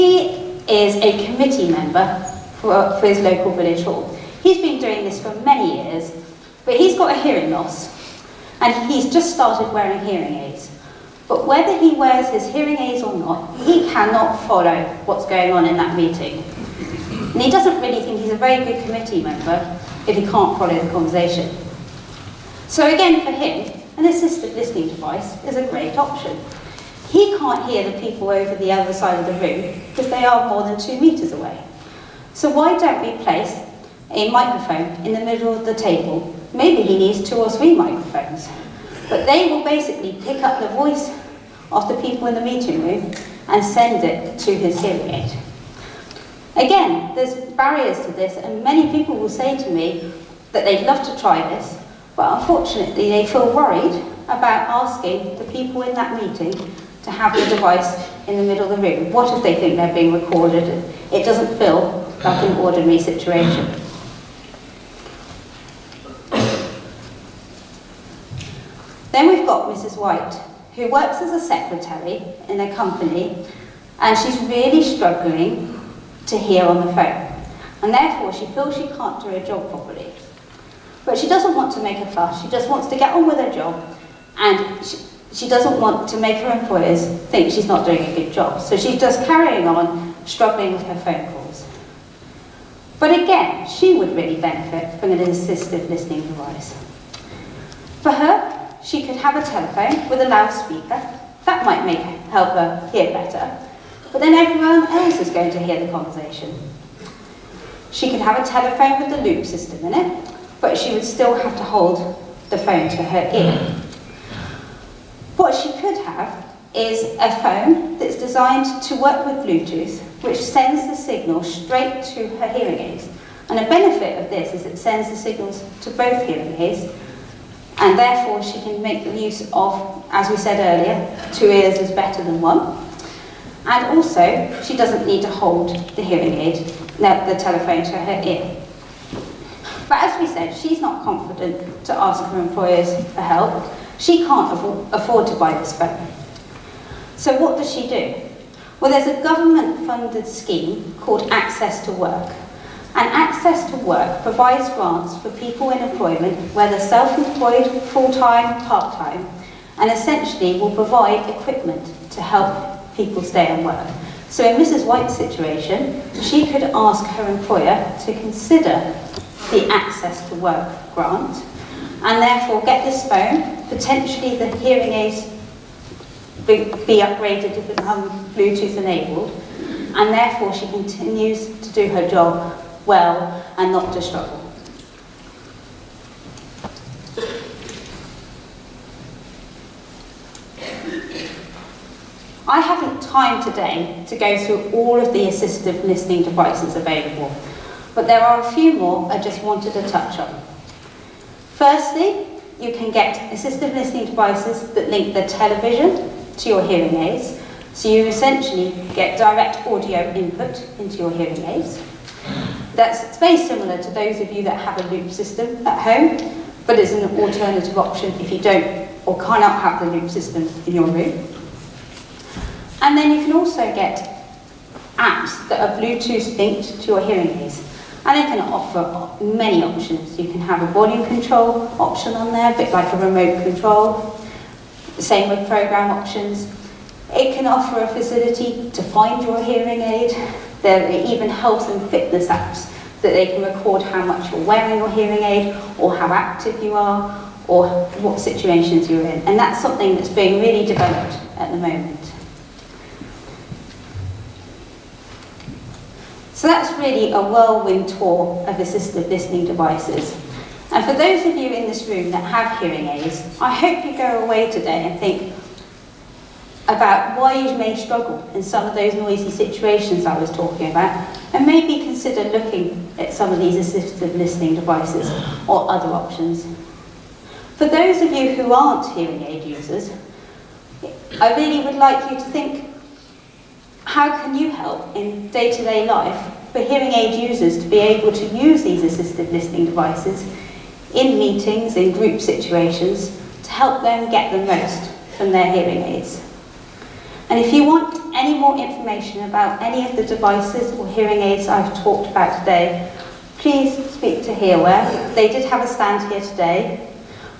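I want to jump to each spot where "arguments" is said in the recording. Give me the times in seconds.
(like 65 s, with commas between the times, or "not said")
not said.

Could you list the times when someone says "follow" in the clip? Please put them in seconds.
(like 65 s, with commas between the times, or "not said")
14 s, 20 s.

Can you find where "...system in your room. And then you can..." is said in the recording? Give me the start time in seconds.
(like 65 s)
220 s.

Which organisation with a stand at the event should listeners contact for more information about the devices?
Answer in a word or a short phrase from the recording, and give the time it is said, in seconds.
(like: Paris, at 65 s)
HearWare, at 304 s.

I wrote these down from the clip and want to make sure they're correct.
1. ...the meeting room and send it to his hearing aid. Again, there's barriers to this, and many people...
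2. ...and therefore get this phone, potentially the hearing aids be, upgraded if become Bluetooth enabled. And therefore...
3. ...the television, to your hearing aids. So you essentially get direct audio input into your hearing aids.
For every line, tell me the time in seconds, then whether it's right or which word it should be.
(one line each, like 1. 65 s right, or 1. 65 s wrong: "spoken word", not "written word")
1. 42 s right
2. 172 s right
3. 205 s right.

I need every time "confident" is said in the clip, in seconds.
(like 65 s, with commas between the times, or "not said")
141 s.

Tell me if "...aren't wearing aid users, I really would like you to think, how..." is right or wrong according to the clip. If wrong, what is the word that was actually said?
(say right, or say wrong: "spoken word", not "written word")
wrong: "hearing", not "wearing".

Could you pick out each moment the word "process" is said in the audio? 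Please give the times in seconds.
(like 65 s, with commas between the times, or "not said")
not said.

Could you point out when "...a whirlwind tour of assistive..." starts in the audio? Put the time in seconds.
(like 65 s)
257 s.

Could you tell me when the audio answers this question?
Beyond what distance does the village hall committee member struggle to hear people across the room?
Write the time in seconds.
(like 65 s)
30 s.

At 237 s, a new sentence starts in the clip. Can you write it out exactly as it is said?
It can offer a facility to find your hearing aid.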